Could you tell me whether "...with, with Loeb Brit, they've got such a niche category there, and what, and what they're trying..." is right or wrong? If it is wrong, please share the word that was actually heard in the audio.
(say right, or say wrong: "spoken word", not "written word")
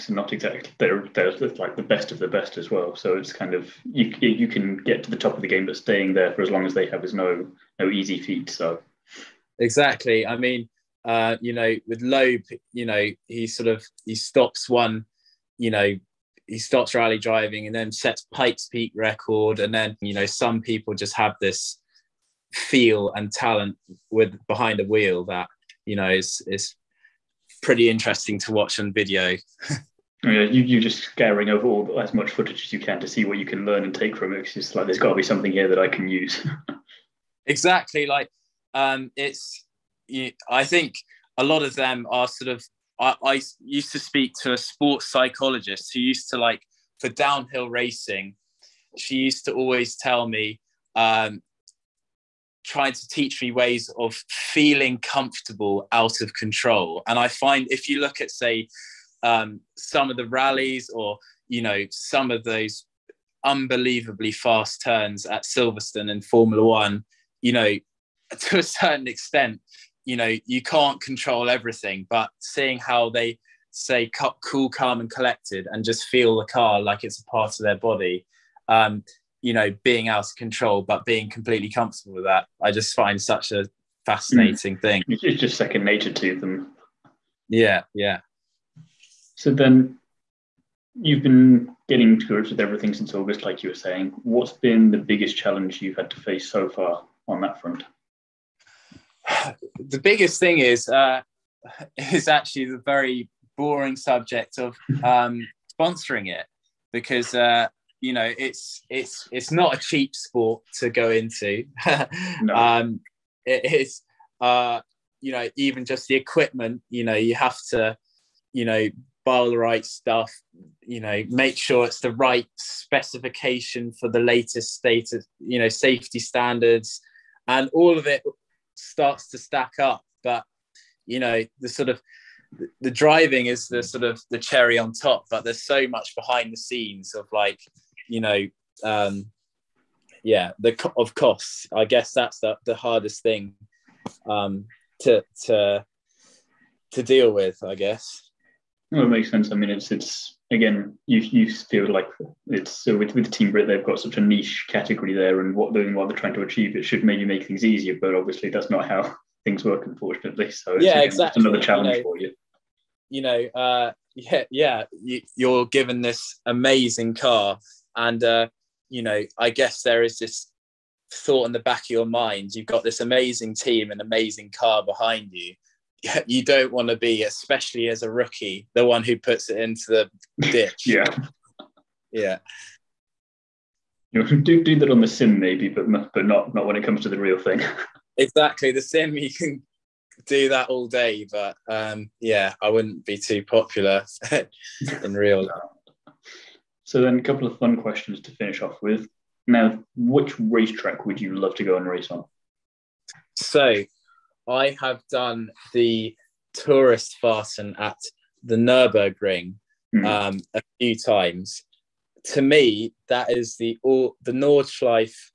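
wrong: "Team", not "Loeb".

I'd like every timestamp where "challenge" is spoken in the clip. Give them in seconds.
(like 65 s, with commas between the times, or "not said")
95 s, 161 s.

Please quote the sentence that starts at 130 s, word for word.
But you know, the sort of the driving is the sort of the cherry on top.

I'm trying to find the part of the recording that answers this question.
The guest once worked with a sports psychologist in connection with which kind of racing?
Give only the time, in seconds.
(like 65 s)
47 s.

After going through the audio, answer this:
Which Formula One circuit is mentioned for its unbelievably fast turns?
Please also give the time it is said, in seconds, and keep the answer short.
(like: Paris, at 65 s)
Silverstone, at 65 s.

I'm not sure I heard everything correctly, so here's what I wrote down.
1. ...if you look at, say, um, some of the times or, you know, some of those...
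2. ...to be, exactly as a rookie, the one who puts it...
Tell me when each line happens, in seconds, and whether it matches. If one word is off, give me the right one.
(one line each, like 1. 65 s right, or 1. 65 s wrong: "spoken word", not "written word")
1. 57 s wrong: "rallies", not "times"
2. 176 s wrong: "especially", not "exactly".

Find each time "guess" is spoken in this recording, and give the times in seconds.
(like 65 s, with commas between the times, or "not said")
141 s, 147 s, 169 s.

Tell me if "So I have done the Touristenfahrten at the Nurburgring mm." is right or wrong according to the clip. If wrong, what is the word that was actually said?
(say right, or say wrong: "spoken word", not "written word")
right.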